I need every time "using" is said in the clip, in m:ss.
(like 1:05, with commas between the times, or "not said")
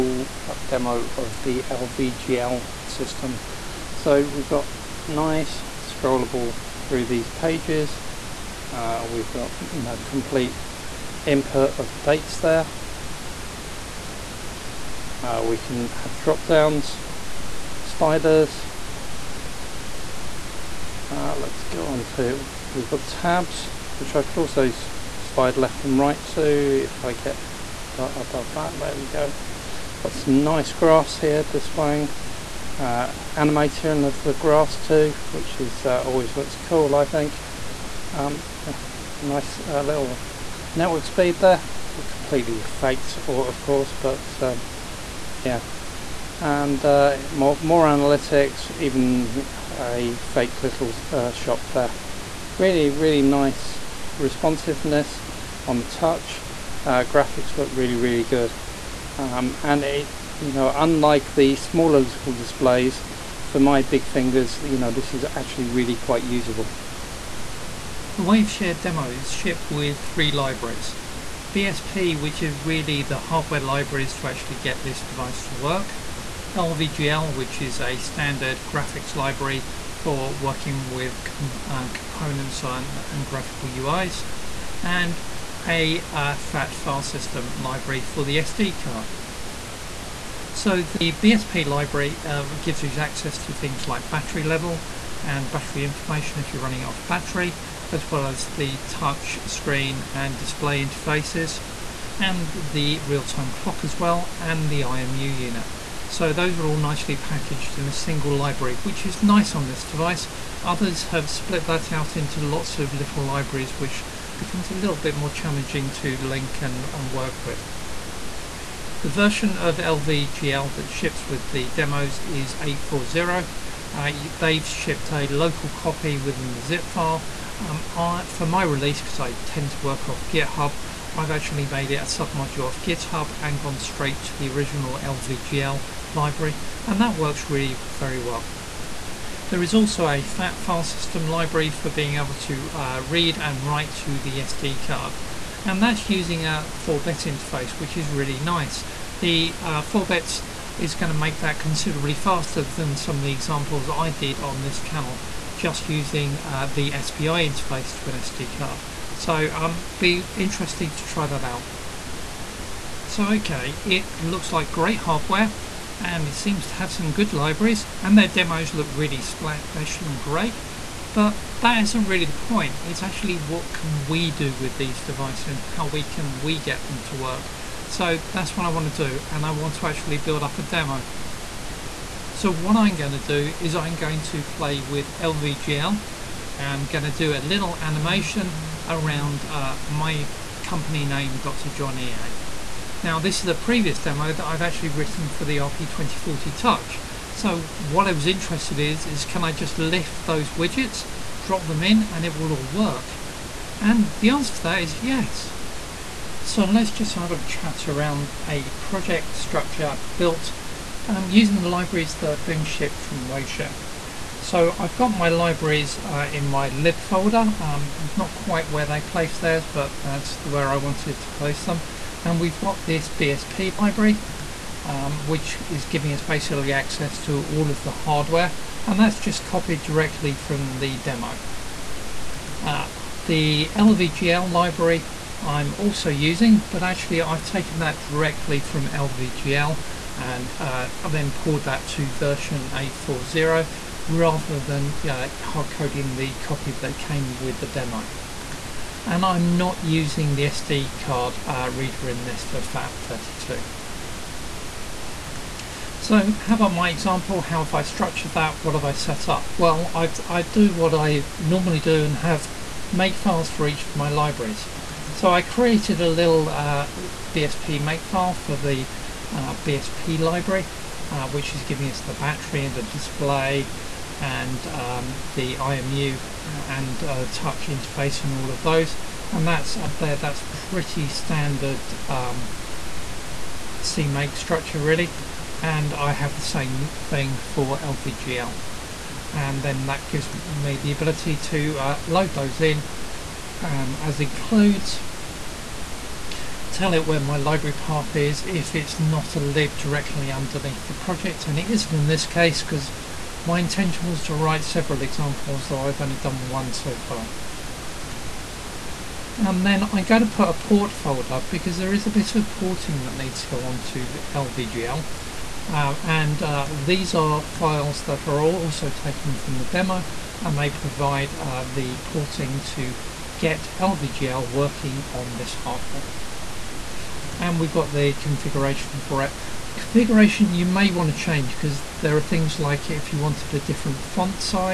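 2:26, 2:35, 3:31, 3:56, 4:09.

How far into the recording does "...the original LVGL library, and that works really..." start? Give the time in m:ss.
2:14.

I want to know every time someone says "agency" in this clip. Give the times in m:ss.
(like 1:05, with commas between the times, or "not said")
not said.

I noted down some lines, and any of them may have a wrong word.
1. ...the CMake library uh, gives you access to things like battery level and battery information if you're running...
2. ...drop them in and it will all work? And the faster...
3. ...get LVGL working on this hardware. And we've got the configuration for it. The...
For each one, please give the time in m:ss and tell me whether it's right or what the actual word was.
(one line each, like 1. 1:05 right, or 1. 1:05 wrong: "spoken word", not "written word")
1. 1:30 wrong: "BSP", not "CMake"
2. 3:21 wrong: "answer", not "faster"
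3. 5:23 right.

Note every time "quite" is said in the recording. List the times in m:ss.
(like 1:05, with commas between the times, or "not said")
1:05, 3:38.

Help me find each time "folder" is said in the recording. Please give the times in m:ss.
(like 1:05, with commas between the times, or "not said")
3:36, 5:10.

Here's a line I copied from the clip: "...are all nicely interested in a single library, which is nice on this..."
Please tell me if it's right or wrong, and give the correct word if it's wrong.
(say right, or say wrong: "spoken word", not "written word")
wrong: "packaged", not "interested".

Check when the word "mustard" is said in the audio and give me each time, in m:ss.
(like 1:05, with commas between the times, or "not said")
not said.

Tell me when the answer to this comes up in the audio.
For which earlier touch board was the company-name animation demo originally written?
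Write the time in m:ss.
3:15.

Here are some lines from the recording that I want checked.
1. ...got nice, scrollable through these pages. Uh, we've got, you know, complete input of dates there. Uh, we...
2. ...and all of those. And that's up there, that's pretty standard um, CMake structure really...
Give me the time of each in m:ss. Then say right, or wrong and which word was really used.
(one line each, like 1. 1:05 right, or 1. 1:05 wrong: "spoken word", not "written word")
1. 0:04 right
2. 4:38 right.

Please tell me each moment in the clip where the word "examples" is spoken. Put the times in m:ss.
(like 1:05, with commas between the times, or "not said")
2:33, 4:16, 5:05.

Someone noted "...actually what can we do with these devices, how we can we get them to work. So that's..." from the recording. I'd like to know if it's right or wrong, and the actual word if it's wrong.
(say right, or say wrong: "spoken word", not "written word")
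right.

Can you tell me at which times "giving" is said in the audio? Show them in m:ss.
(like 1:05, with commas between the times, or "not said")
3:45, 4:31.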